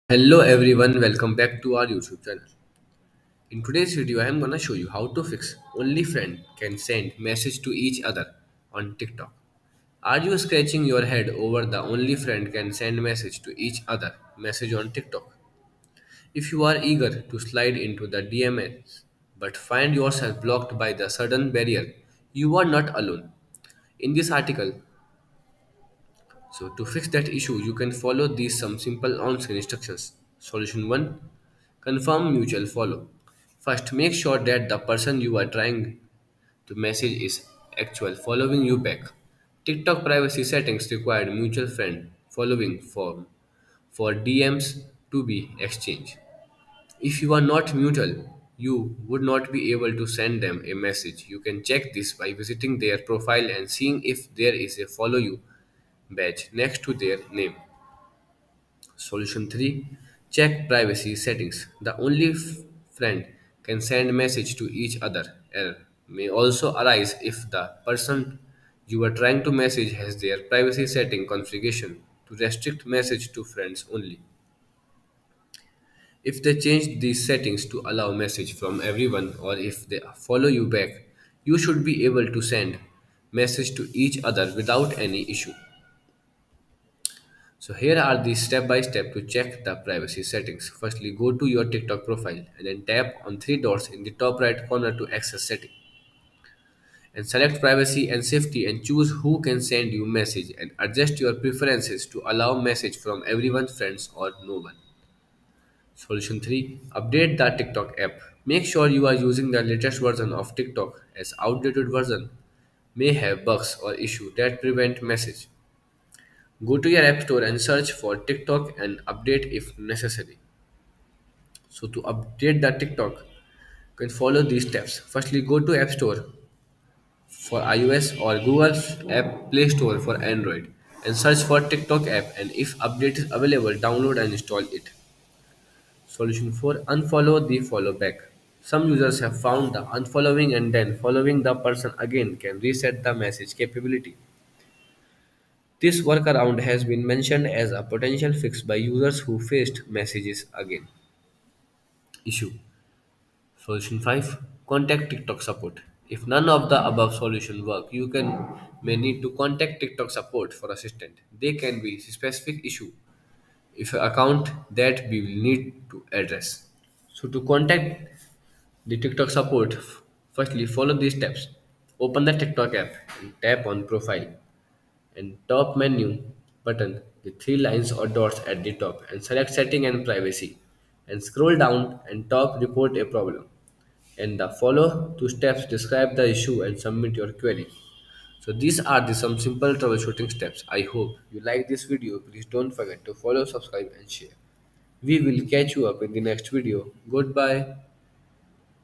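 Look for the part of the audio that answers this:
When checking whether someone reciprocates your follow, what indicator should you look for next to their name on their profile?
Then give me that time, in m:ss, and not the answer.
0:54.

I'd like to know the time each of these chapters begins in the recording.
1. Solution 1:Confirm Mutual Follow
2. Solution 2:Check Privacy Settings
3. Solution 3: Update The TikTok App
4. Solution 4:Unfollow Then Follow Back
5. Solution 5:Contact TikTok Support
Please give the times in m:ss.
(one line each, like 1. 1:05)
1. 0:31
2. 1:00
3. 1:46
4. 2:16
5. 2:37.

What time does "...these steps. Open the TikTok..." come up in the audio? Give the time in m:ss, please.
2:51.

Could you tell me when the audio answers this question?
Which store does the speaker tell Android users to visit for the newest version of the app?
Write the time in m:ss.
2:08.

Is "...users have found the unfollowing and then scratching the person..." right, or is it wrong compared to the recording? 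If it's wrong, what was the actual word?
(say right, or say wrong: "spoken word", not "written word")
wrong: "following", not "scratching".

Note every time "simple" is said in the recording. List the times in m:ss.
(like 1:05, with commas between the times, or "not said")
0:28, 3:09.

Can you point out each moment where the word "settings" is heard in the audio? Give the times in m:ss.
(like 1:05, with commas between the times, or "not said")
0:40, 1:01, 1:10, 1:17, 1:30, 1:35, 2:59.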